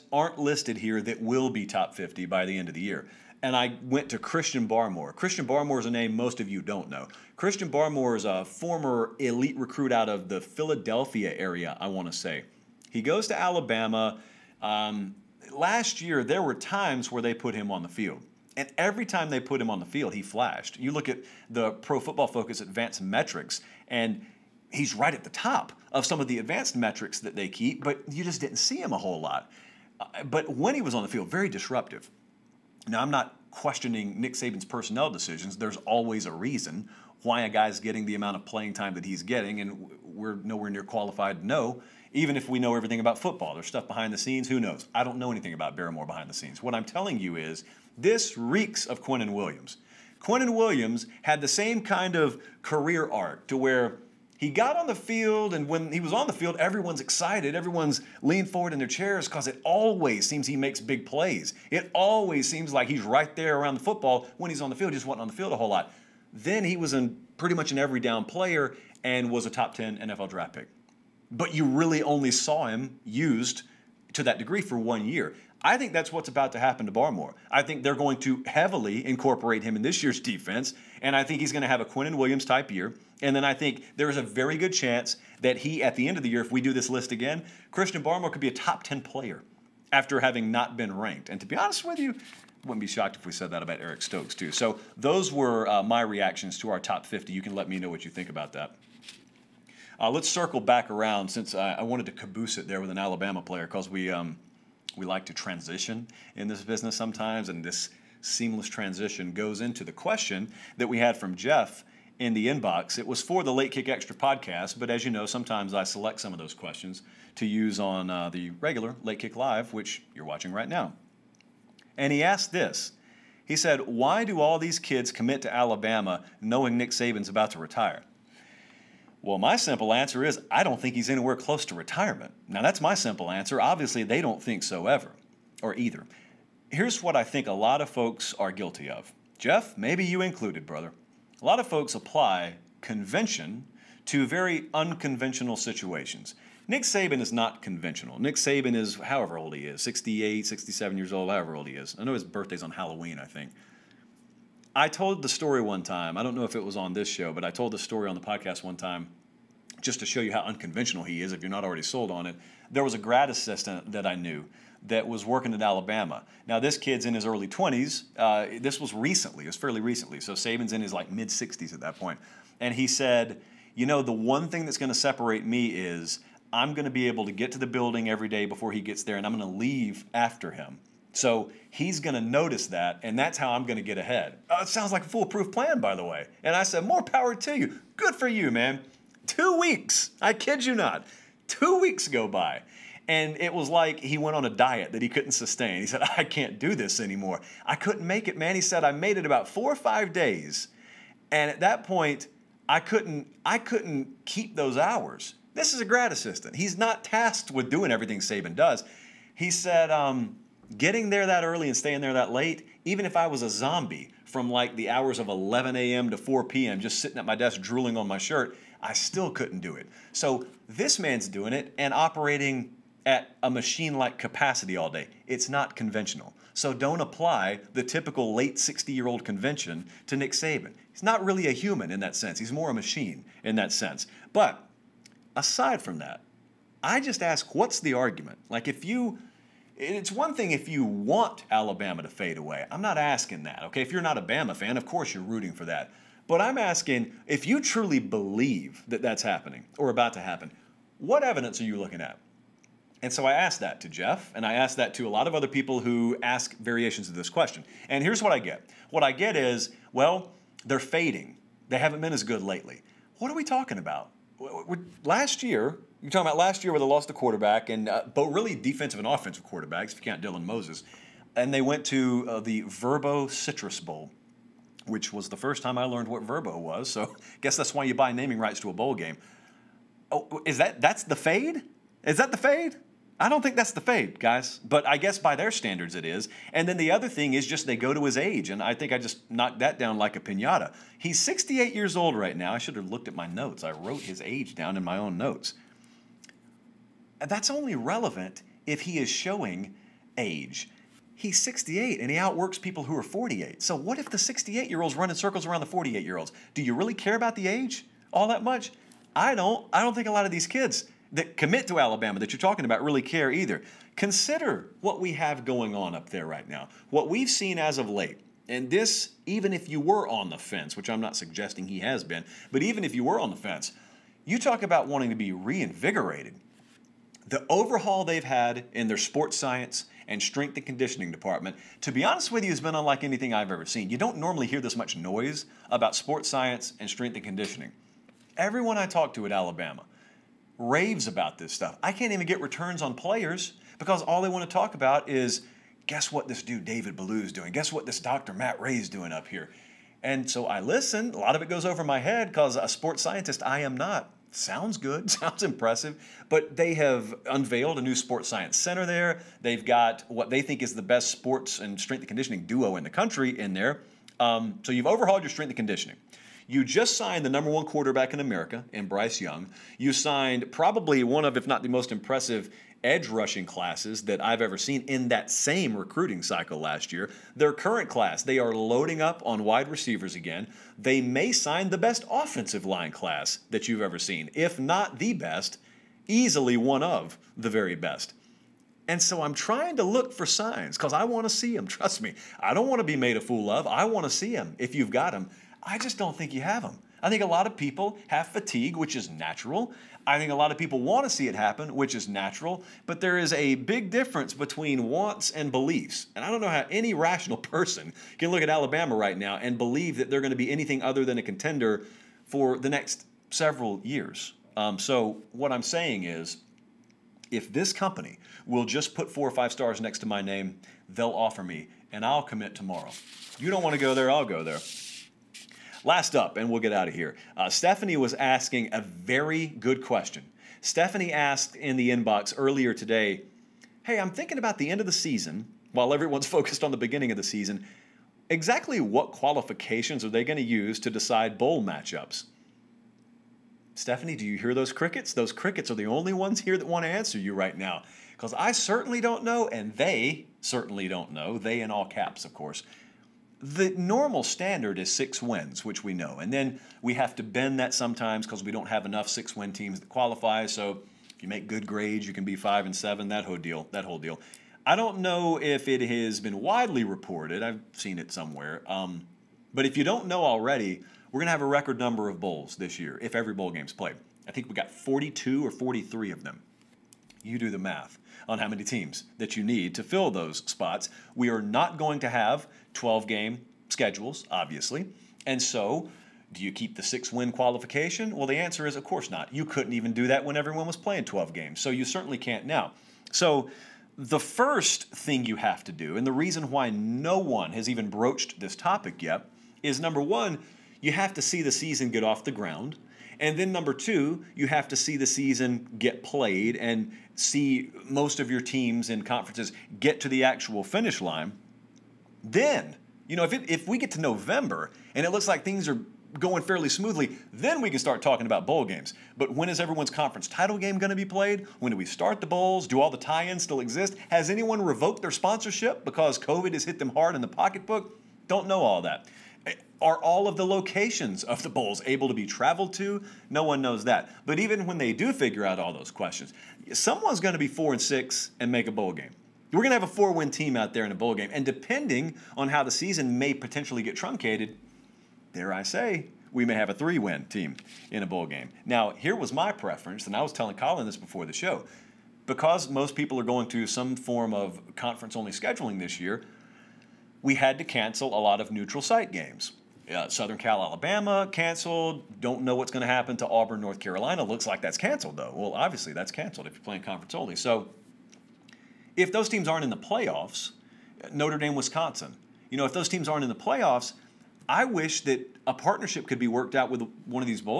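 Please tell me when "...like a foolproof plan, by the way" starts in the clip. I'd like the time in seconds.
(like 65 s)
184 s.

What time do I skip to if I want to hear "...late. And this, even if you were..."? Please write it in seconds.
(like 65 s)
317 s.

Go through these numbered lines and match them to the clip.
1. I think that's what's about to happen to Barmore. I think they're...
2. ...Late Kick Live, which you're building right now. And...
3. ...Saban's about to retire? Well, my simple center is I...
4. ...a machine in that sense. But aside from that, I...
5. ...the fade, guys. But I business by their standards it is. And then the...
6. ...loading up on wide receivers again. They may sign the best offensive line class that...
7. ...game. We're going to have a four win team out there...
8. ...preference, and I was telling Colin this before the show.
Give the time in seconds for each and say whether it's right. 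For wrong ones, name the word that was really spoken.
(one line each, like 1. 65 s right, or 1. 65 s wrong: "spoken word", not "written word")
1. 75 s right
2. 119 s wrong: "watching", not "building"
3. 126 s wrong: "answer", not "center"
4. 232 s right
5. 283 s wrong: "guess", not "business"
6. 378 s right
7. 538 s right
8. 549 s right.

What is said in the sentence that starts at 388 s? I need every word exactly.
And so I'm trying to look for signs because I want to see them.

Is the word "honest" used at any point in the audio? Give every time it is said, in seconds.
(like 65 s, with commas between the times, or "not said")
91 s, 332 s.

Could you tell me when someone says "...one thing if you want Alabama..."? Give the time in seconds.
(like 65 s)
240 s.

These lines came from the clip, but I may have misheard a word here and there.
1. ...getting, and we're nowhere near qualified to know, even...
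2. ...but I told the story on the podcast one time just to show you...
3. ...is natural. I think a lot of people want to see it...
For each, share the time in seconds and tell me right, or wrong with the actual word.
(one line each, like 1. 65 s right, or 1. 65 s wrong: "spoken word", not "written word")
1. 39 s right
2. 157 s right
3. 398 s right.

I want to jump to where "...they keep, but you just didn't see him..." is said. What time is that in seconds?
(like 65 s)
27 s.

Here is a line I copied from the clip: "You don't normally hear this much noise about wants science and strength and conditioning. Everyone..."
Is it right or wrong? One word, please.
wrong.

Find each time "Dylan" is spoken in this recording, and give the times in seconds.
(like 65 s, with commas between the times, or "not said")
270 s.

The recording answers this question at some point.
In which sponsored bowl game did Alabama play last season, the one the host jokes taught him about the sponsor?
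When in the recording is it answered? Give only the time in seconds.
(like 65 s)
272 s.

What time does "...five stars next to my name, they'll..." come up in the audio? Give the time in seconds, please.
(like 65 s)
419 s.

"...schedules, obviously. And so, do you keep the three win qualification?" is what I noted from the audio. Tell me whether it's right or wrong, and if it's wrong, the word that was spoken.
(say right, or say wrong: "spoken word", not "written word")
wrong: "six", not "three".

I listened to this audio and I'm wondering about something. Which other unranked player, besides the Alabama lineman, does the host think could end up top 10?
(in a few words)
Eric Stokes.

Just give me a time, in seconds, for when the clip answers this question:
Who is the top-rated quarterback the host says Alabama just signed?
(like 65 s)
368 s.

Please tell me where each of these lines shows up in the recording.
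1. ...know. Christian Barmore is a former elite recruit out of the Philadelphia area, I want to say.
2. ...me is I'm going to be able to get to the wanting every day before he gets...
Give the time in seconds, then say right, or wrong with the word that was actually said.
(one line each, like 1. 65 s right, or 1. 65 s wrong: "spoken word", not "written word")
1. 6 s right
2. 175 s wrong: "building", not "wanting".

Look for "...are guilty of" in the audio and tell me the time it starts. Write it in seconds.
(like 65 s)
138 s.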